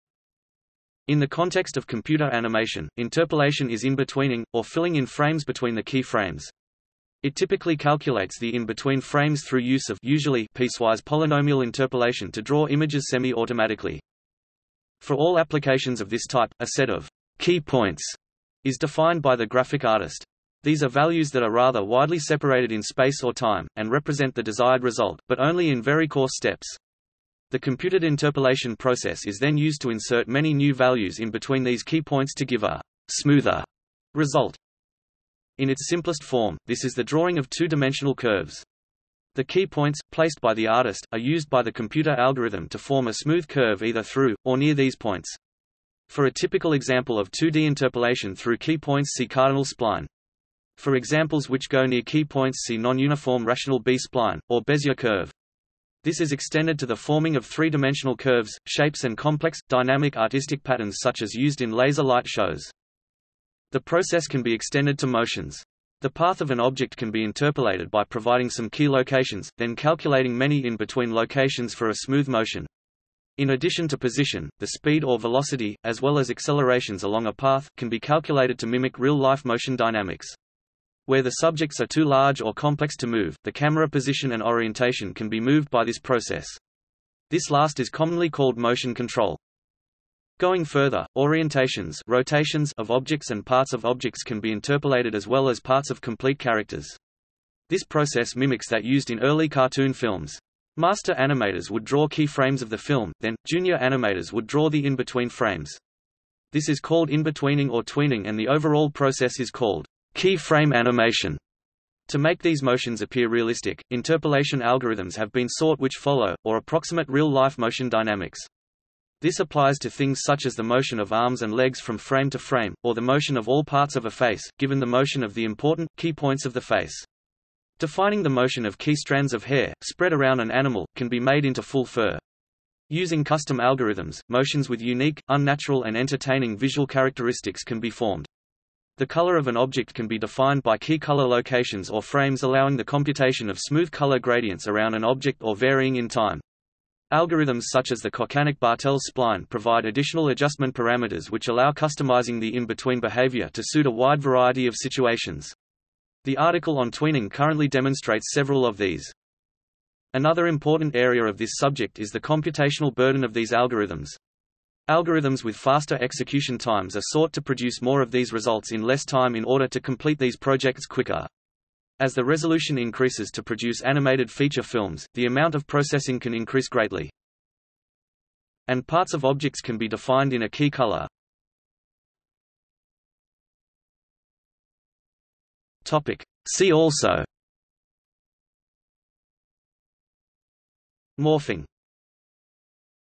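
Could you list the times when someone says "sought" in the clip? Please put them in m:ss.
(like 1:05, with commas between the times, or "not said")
1:55, 2:47.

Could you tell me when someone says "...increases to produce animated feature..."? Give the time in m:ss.
2:52.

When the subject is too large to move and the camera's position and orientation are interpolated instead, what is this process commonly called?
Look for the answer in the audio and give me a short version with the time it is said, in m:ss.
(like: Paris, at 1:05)
Motion control, at 1:28.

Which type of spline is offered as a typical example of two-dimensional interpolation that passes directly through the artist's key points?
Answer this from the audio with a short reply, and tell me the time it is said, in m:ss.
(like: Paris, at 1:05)
Cardinal spline, at 0:49.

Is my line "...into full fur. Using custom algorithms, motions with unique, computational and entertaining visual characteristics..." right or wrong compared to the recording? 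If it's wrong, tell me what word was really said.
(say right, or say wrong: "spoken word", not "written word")
wrong: "unnatural", not "computational".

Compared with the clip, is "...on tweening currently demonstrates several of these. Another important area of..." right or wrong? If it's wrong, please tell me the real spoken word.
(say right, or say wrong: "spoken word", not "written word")
right.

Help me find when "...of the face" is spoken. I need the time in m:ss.
2:06.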